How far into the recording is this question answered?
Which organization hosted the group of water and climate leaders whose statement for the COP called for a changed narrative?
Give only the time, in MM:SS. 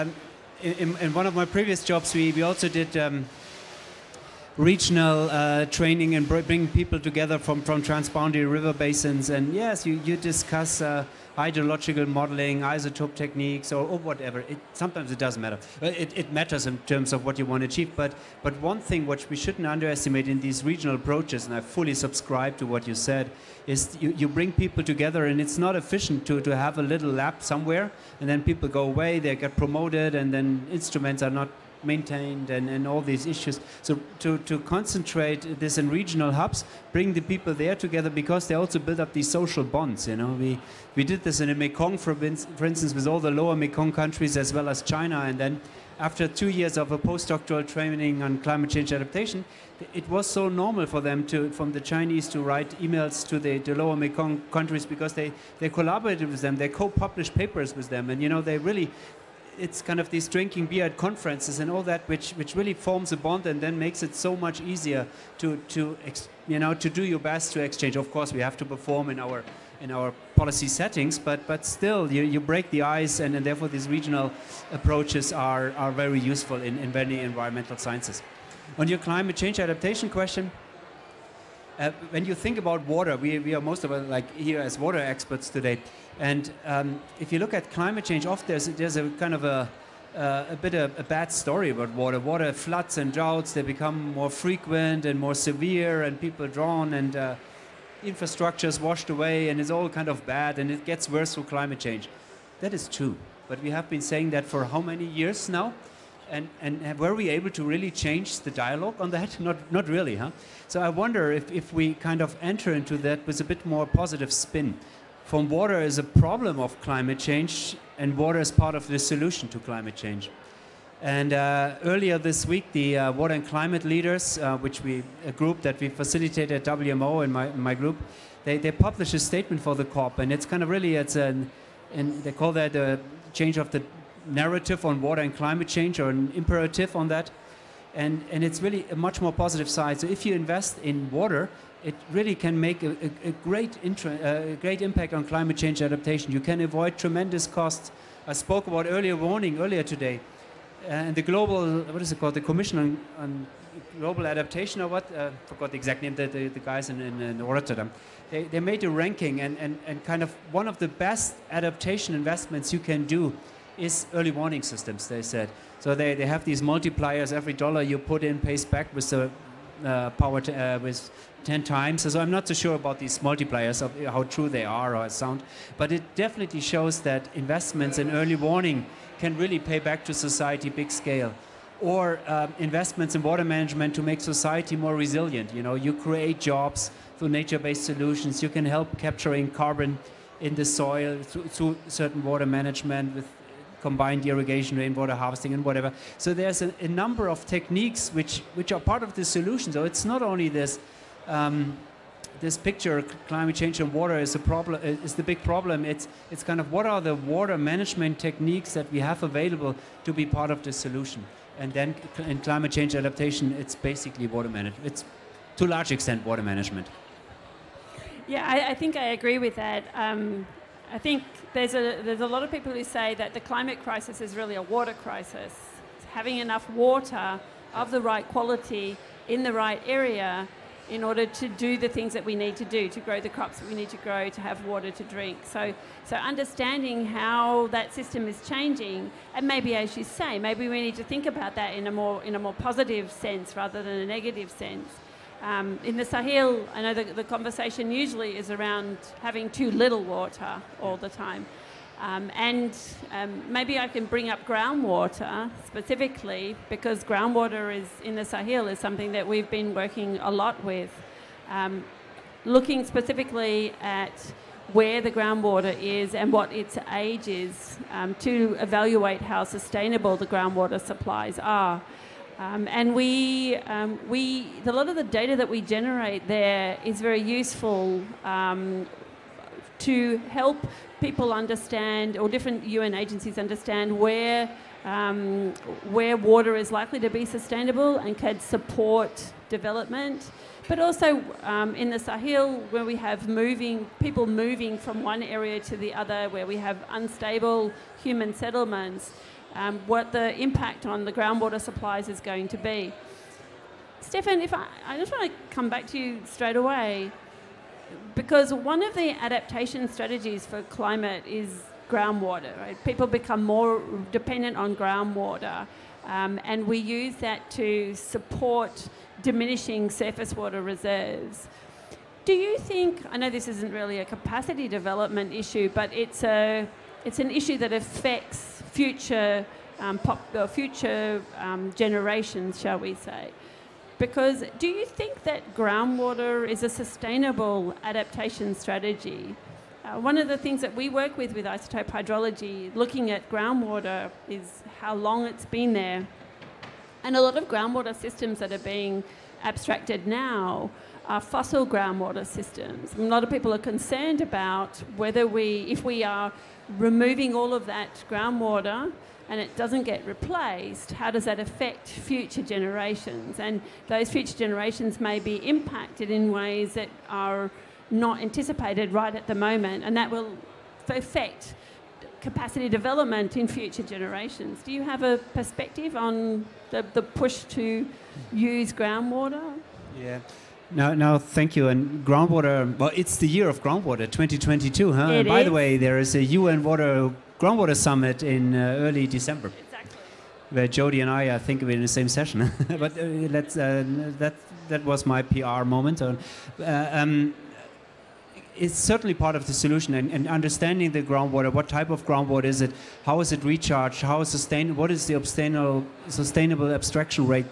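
02:06.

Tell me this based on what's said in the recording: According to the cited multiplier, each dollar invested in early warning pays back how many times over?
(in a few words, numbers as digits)
10 times.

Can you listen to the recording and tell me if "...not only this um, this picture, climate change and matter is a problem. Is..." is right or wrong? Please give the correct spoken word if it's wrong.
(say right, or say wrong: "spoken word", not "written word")
wrong: "water", not "matter".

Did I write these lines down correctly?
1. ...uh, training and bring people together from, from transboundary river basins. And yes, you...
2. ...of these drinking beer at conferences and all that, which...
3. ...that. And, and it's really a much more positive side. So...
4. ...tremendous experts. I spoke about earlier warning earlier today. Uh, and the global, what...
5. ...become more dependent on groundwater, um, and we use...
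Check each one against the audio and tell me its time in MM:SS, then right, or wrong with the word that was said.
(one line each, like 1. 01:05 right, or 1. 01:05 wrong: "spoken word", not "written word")
1. 00:05 right
2. 00:59 right
3. 02:17 right
4. 02:26 wrong: "costs", not "experts"
5. 05:13 right.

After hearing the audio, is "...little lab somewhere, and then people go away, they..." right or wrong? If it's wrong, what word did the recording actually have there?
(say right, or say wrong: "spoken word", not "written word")
right.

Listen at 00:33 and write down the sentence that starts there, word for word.
So to, to concentrate this in regional hubs, bring the people there together because they also build up these social bonds.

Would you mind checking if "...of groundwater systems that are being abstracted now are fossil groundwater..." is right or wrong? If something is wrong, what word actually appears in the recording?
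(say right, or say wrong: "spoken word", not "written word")
right.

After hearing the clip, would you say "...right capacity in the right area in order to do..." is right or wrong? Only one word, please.
wrong.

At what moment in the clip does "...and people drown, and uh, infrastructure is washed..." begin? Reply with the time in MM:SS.
01:36.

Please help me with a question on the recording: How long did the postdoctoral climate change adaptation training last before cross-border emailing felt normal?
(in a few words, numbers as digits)
2.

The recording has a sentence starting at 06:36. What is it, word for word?
Uh, um, it's certainly part of the solution and, and, understanding the groundwater.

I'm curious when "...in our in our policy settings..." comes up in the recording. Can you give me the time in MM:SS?
01:09.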